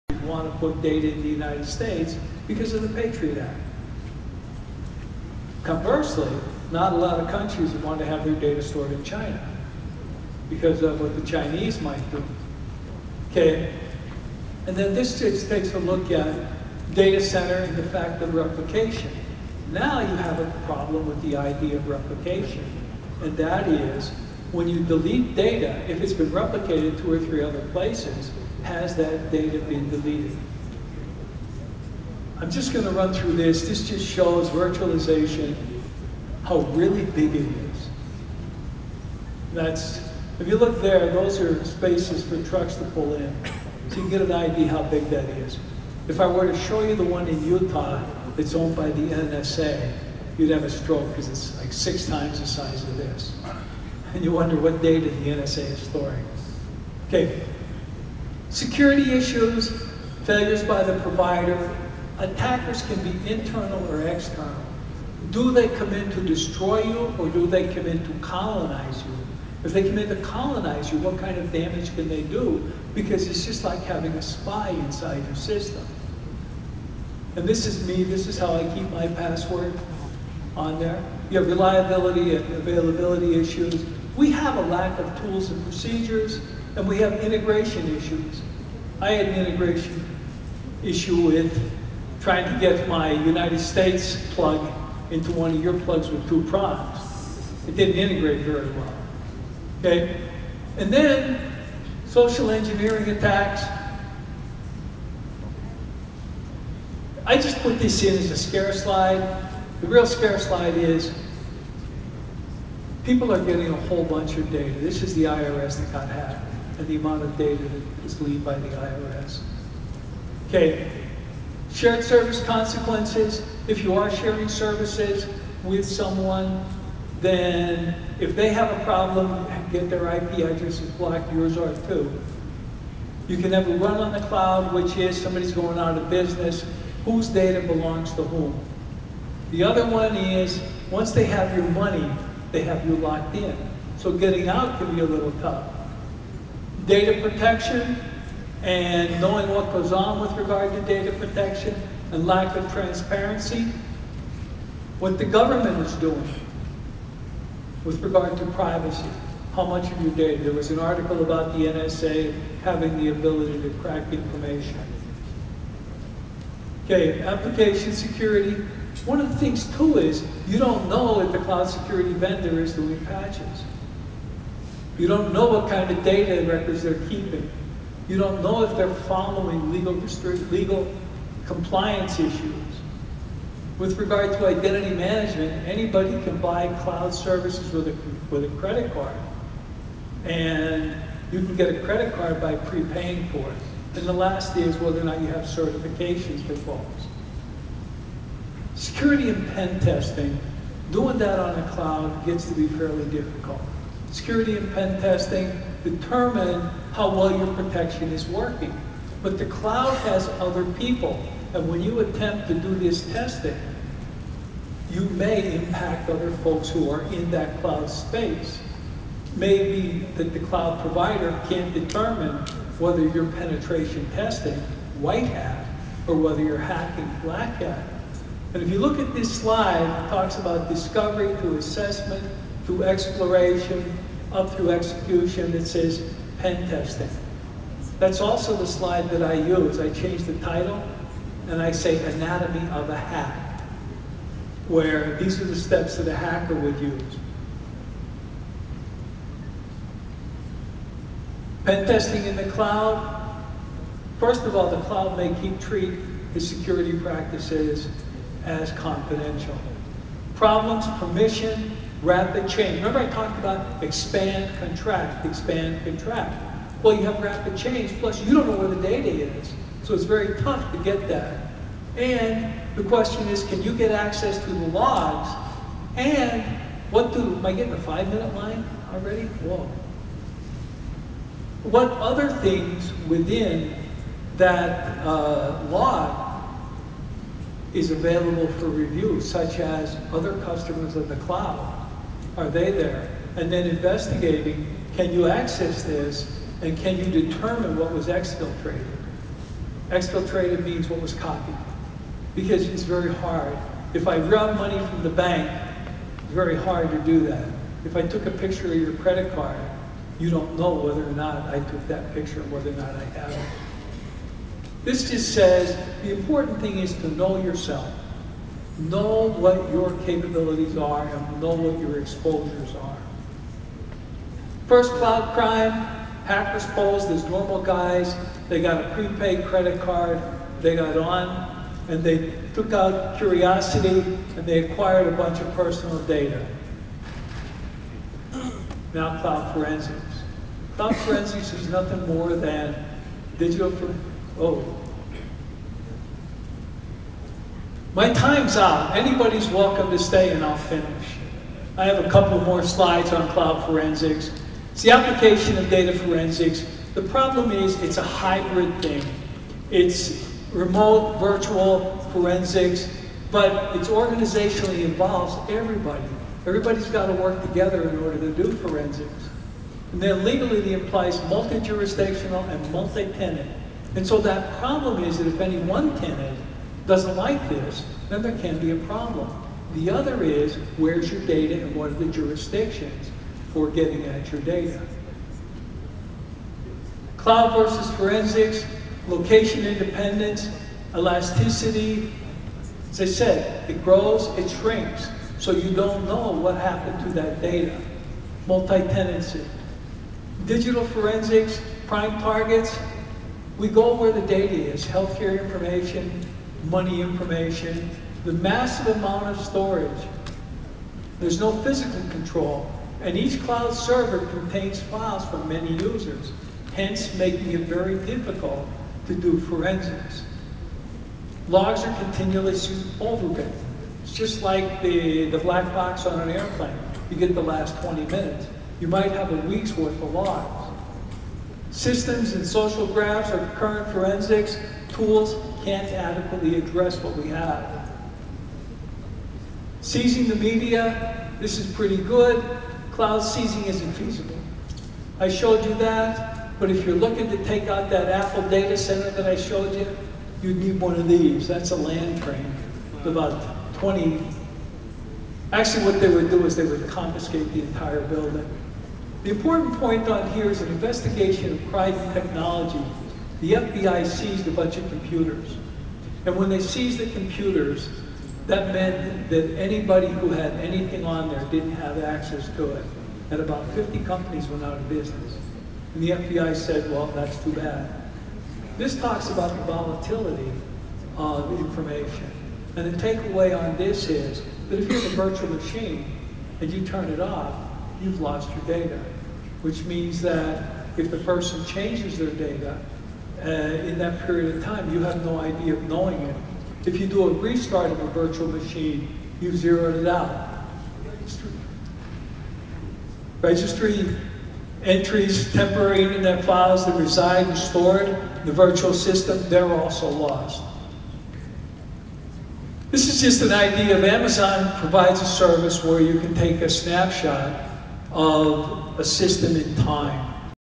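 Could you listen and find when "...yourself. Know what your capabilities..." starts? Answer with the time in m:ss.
5:17.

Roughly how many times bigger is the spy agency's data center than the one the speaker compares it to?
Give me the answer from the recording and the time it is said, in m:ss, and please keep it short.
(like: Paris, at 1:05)
6, at 0:51.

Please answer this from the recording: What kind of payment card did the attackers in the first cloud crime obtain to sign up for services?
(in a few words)
Prepaid credit card.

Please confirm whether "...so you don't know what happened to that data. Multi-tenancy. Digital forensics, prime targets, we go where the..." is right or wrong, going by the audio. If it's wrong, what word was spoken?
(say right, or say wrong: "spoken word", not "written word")
right.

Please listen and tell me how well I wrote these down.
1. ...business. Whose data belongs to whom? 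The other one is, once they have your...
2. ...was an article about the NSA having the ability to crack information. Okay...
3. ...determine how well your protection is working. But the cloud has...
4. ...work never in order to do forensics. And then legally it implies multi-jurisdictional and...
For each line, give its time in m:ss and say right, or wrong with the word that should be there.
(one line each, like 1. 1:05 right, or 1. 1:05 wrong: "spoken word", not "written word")
1. 2:16 right
2. 2:40 right
3. 3:25 right
4. 6:07 wrong: "together", not "never".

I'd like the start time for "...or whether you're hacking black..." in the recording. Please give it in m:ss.
3:46.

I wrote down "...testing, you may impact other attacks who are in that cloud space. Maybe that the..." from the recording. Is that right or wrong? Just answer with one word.
wrong.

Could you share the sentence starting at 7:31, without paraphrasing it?
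That's a land train with about 20.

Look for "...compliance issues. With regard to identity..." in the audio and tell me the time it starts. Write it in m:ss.
3:01.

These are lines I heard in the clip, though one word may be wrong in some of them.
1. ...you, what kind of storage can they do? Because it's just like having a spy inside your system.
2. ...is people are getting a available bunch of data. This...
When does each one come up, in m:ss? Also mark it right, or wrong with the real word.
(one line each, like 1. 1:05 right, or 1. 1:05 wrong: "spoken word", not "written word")
1. 1:10 wrong: "damage", not "storage"
2. 1:50 wrong: "whole", not "available".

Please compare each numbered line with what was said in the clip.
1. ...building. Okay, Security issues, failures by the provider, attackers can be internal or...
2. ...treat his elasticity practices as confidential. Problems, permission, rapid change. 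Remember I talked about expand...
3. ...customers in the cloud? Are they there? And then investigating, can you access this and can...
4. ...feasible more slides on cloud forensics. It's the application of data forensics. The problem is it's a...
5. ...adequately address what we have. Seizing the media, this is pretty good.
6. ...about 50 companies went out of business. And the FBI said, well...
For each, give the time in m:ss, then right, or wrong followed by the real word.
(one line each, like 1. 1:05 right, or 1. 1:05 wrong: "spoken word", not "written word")
1. 0:55 wrong: "storing", not "building"
2. 4:15 wrong: "security", not "elasticity"
3. 4:50 right
4. 5:52 wrong: "couple", not "feasible"
5. 7:15 right
6. 7:53 right.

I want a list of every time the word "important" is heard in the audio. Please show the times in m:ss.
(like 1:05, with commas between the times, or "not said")
5:16, 7:39.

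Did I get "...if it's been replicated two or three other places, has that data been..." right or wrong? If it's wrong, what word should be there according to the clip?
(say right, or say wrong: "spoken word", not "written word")
right.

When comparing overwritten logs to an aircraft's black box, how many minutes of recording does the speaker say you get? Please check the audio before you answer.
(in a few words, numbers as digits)
20 minutes.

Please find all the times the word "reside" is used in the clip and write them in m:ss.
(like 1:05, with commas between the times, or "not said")
8:26.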